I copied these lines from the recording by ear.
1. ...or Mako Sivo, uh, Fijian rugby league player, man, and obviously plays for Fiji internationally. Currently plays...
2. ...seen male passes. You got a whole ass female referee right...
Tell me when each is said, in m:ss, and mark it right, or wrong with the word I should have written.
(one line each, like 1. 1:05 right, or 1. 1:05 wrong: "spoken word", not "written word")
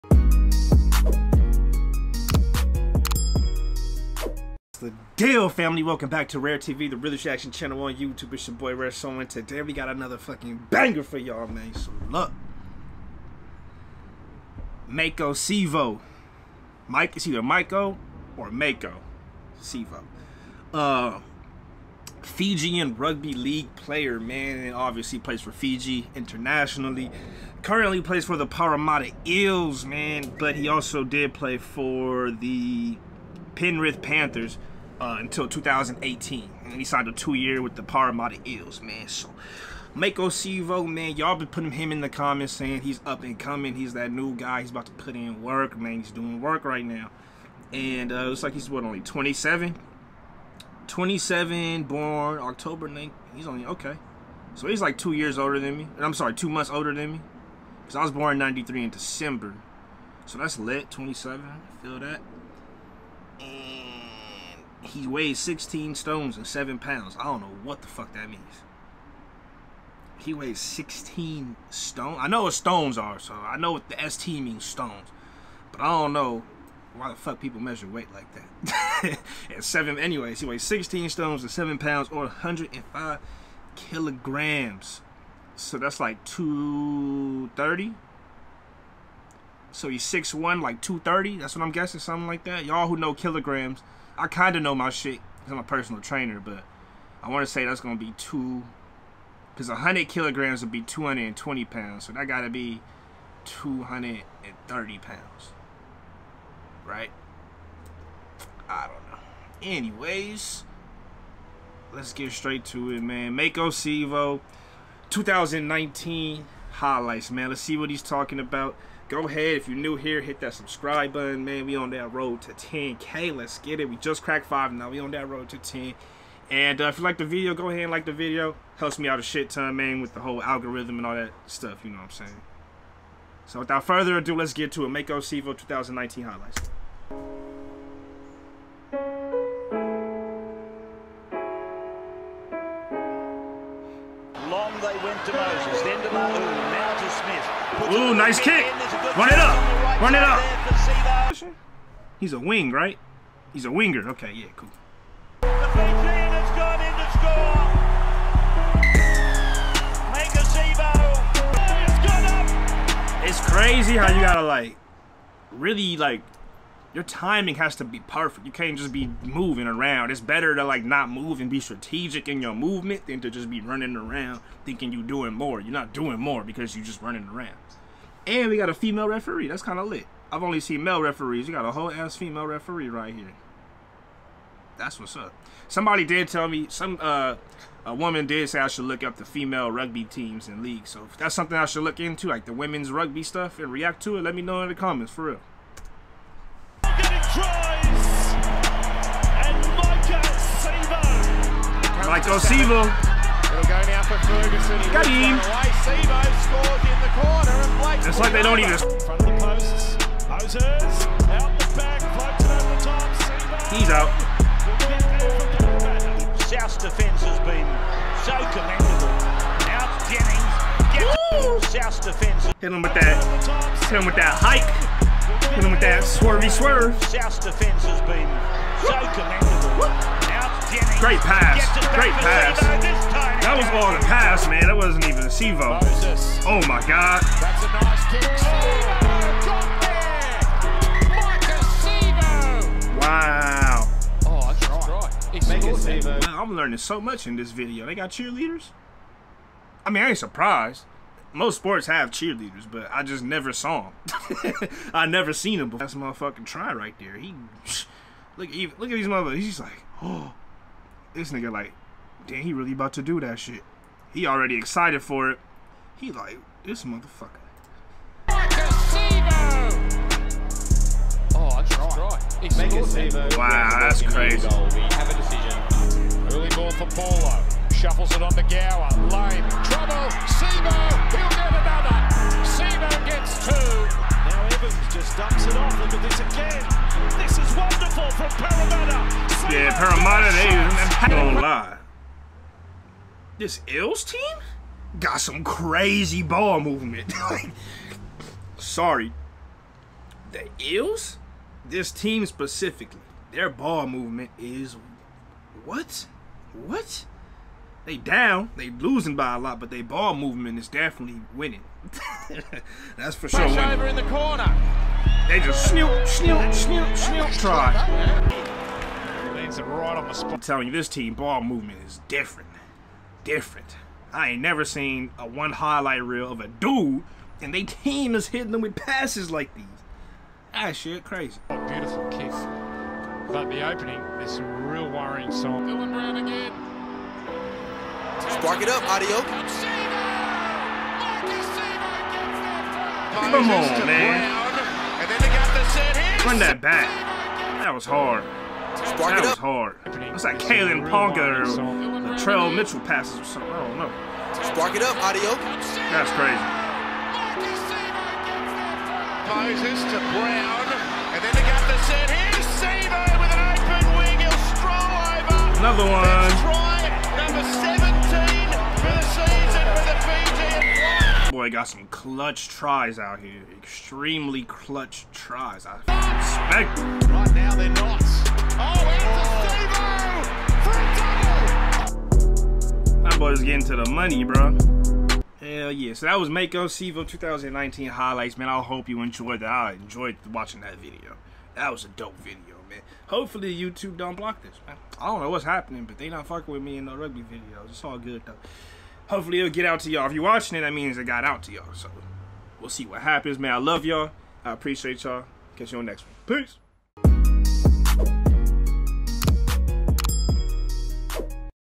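1. 0:18 right
2. 3:00 wrong: "referees", not "passes".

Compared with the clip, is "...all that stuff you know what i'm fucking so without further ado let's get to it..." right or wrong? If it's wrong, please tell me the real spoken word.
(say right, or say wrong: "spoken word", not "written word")
wrong: "saying", not "fucking".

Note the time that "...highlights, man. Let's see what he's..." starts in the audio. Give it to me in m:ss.
1:56.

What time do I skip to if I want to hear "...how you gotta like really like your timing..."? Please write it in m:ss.
2:43.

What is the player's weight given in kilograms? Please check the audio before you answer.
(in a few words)
105.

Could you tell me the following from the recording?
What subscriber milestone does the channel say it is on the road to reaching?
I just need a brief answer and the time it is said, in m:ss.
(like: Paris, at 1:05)
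10k, at 2:02.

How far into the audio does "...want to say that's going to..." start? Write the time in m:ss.
1:37.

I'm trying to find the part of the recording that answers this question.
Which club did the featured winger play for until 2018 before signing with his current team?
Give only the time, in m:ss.
0:33.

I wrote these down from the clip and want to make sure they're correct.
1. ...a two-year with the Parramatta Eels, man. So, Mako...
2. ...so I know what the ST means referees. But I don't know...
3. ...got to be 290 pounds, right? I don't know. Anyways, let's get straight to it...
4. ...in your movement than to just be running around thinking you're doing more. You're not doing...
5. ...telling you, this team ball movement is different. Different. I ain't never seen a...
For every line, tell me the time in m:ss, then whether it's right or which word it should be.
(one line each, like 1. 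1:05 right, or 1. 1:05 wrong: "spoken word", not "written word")
1. 0:37 right
2. 1:13 wrong: "stones", not "referees"
3. 1:42 wrong: "230", not "290"
4. 2:52 right
5. 5:20 right.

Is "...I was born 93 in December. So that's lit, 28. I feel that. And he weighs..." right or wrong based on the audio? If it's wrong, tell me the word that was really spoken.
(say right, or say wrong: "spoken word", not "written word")
wrong: "27", not "28".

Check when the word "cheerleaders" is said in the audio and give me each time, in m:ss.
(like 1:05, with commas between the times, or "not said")
4:08, 4:12.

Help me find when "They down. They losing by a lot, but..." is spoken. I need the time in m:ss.
5:07.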